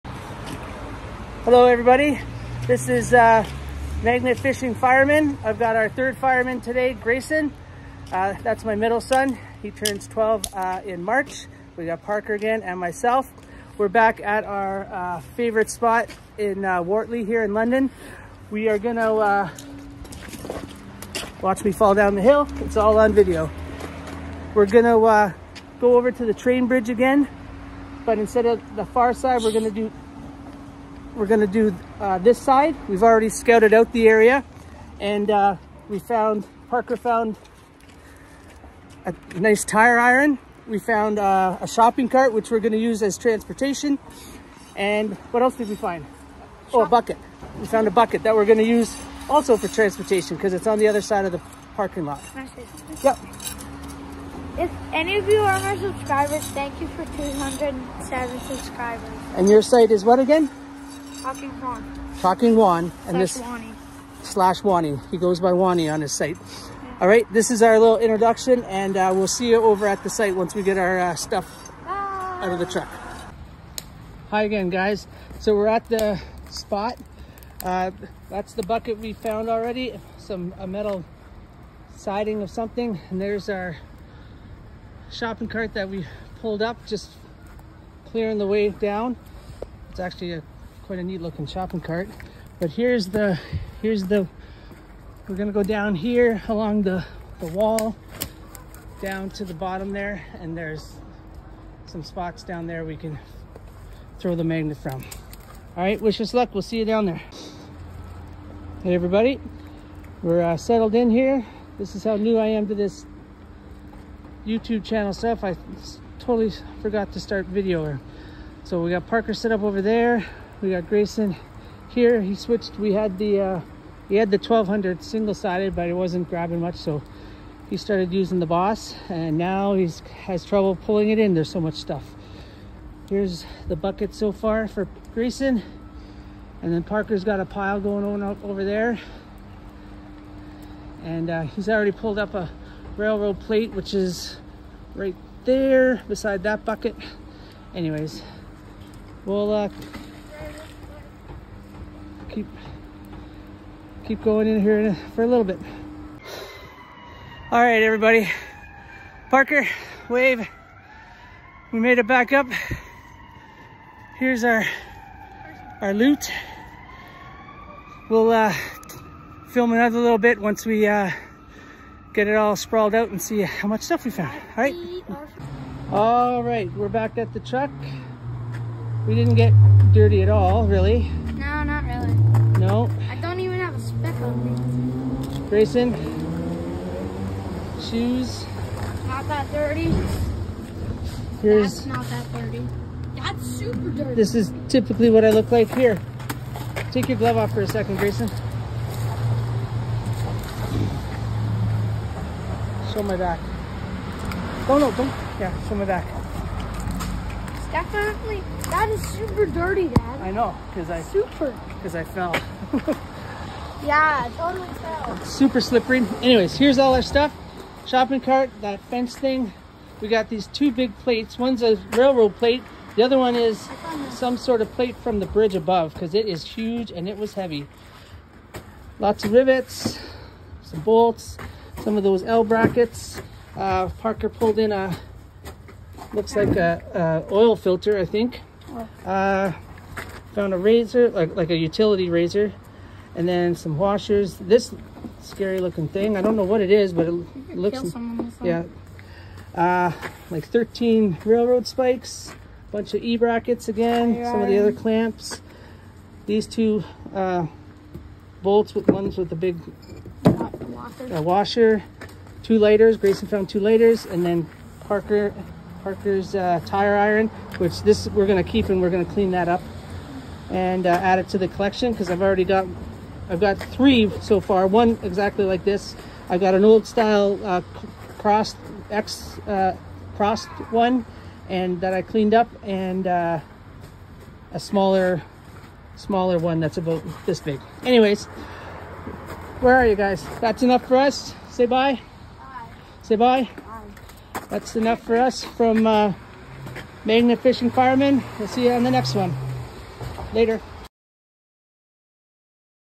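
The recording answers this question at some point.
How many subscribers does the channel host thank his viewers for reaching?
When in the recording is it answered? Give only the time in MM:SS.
00:57.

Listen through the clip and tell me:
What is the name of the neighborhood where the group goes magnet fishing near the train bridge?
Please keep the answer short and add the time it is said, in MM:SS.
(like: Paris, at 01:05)
Wortley, at 00:16.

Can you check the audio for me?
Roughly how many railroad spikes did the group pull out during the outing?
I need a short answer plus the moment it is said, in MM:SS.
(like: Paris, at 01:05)
13, at 04:10.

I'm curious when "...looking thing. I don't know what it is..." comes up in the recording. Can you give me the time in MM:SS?
04:05.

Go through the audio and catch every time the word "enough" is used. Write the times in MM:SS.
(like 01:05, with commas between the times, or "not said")
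04:50, 04:54.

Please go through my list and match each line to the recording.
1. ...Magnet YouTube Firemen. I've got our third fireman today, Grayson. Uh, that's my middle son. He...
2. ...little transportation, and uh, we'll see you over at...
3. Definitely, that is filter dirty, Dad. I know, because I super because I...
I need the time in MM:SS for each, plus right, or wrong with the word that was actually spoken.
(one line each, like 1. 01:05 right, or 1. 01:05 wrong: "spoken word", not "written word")
1. 00:04 wrong: "Fishing", not "YouTube"
2. 01:07 wrong: "introduction", not "transportation"
3. 03:27 wrong: "super", not "filter".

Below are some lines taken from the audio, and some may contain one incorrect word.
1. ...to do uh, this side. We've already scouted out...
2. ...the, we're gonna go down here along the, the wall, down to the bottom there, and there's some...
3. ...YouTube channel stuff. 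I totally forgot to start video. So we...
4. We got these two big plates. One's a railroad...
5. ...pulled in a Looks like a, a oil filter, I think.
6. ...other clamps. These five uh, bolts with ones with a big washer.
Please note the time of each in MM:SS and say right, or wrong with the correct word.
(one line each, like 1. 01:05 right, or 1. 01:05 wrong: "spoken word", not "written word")
1. 00:31 right
2. 01:34 right
3. 01:54 right
4. 03:40 right
5. 03:54 right
6. 04:14 wrong: "two", not "five".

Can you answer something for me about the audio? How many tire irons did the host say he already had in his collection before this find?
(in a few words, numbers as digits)
3.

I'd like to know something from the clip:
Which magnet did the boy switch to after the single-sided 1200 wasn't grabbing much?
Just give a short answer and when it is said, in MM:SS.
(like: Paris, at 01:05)
The Boss, at 02:08.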